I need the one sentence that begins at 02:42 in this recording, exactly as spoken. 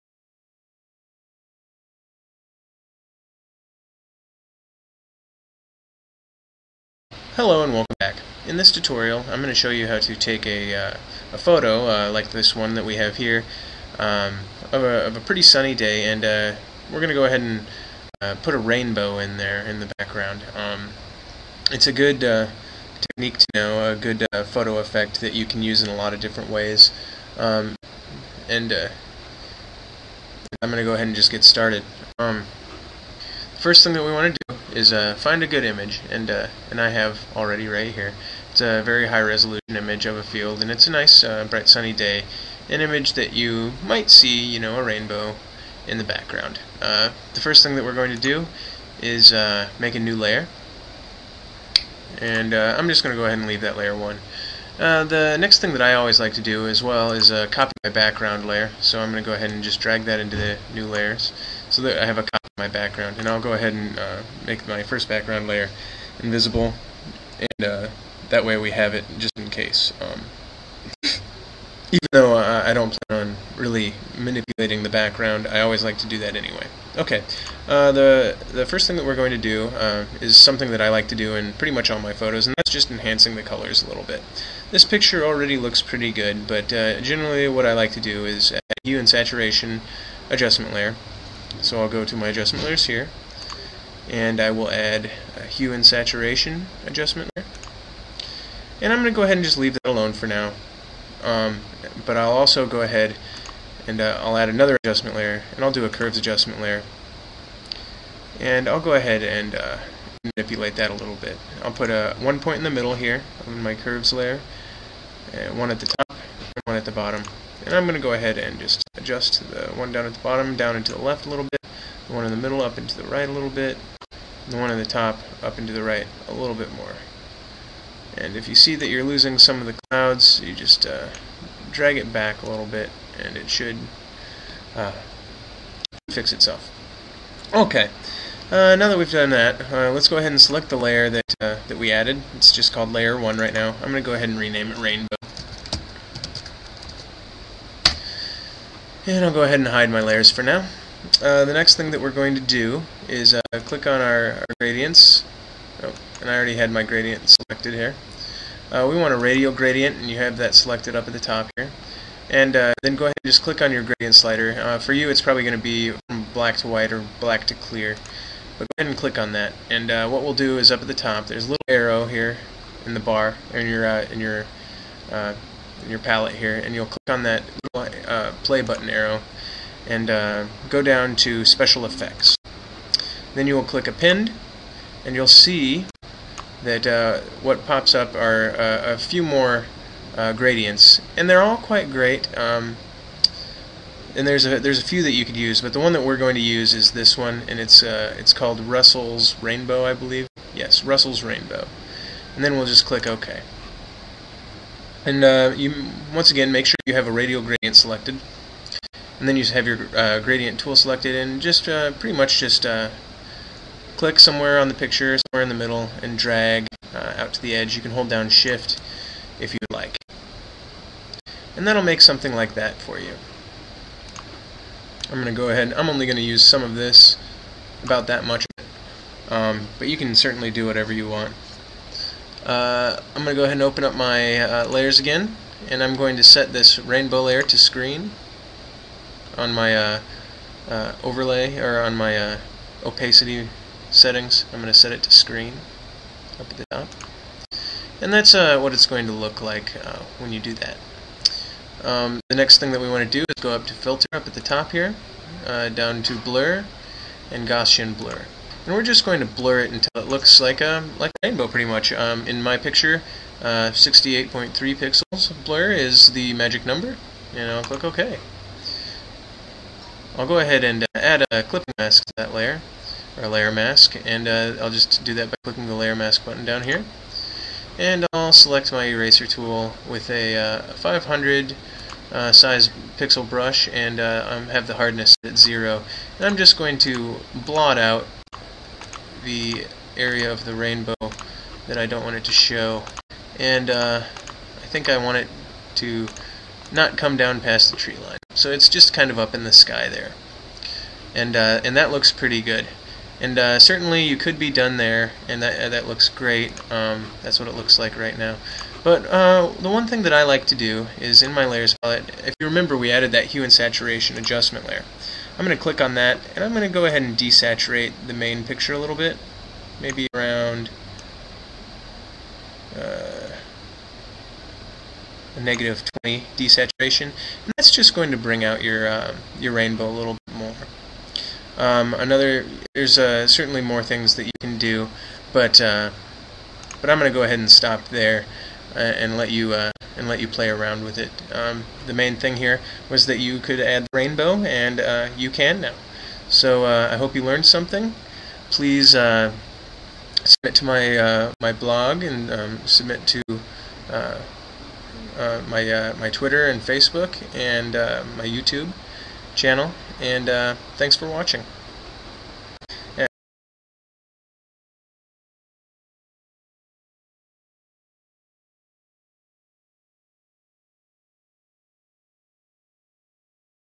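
And uh, then go ahead and just click on your gradient slider.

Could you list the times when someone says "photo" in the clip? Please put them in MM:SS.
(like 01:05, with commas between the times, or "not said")
00:11, 00:24, 01:22.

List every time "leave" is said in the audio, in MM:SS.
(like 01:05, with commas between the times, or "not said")
00:53, 01:39.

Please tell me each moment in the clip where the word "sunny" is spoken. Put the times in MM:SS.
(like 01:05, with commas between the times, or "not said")
00:15, 00:41.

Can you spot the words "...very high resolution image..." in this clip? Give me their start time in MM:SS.
00:38.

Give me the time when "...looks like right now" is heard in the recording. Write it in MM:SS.
05:07.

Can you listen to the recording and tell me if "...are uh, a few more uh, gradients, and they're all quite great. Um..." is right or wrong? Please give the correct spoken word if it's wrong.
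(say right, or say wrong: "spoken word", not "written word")
right.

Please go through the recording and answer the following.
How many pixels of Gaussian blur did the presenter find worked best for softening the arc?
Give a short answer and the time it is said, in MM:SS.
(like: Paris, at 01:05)
68.3, at 04:23.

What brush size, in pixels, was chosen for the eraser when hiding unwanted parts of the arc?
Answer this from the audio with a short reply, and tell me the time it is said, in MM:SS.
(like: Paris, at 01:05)
500, at 04:40.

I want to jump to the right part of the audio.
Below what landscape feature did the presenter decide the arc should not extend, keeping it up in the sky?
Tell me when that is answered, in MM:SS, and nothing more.
04:57.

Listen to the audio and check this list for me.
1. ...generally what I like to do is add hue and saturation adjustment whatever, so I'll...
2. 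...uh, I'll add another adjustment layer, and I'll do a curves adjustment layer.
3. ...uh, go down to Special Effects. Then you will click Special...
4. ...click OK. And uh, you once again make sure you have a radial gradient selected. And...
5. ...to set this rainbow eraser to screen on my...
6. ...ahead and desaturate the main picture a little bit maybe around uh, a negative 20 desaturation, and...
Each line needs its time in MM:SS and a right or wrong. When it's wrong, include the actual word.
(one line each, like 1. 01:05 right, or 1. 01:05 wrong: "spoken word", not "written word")
1. 01:27 wrong: "layer", not "whatever"
2. 01:44 right
3. 03:00 wrong: "Append", not "Special"
4. 03:22 right
5. 03:56 wrong: "layer", not "eraser"
6. 05:16 right.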